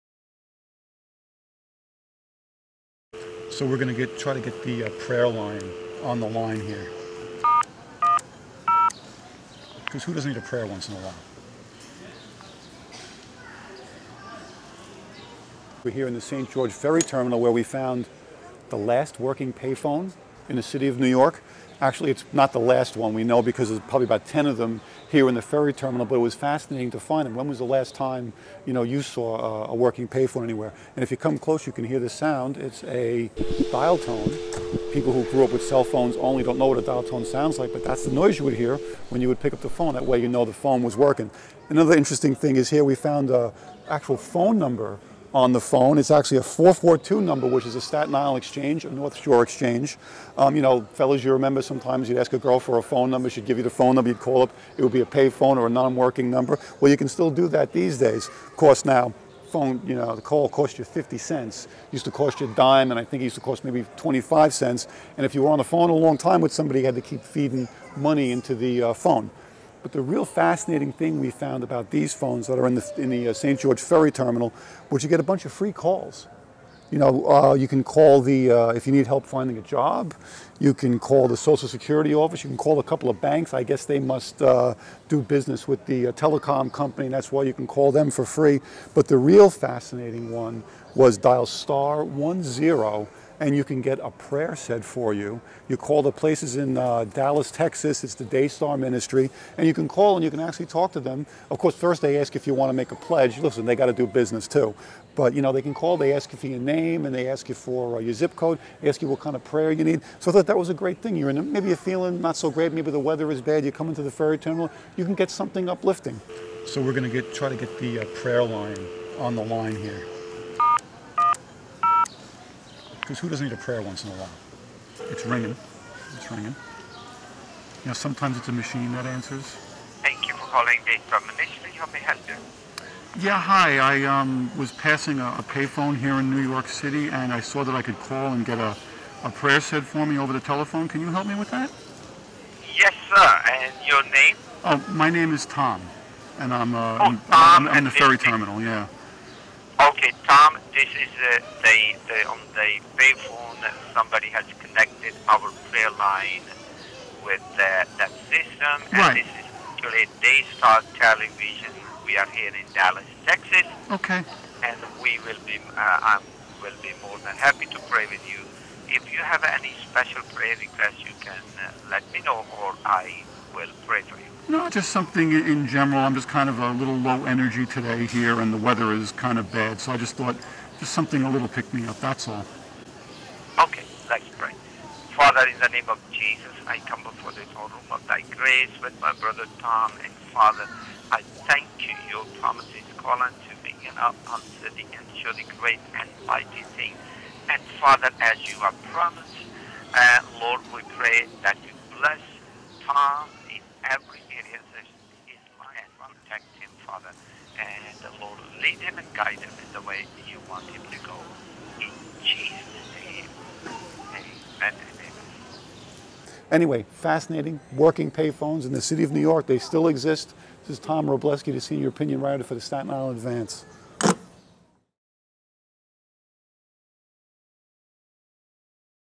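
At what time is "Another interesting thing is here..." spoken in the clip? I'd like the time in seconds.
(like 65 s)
41 s.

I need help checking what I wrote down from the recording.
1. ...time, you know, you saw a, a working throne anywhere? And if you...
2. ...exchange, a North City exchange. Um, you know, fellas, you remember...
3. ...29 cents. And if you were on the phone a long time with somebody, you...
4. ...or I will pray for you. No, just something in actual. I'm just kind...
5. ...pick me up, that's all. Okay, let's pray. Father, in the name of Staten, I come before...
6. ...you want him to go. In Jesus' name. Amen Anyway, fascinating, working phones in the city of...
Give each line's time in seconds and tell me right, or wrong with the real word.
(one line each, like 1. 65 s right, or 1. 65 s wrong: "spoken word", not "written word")
1. 27 s wrong: "payphone", not "throne"
2. 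48 s wrong: "Shore", not "City"
3. 63 s wrong: "25", not "29"
4. 172 s wrong: "general", not "actual"
5. 181 s wrong: "Jesus", not "Staten"
6. 210 s wrong: "payphones", not "phones".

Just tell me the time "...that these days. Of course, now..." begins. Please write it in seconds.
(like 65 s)
57 s.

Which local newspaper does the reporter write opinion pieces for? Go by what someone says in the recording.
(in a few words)
Staten Island Advance.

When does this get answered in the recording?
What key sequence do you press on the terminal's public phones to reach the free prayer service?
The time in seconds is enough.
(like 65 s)
91 s.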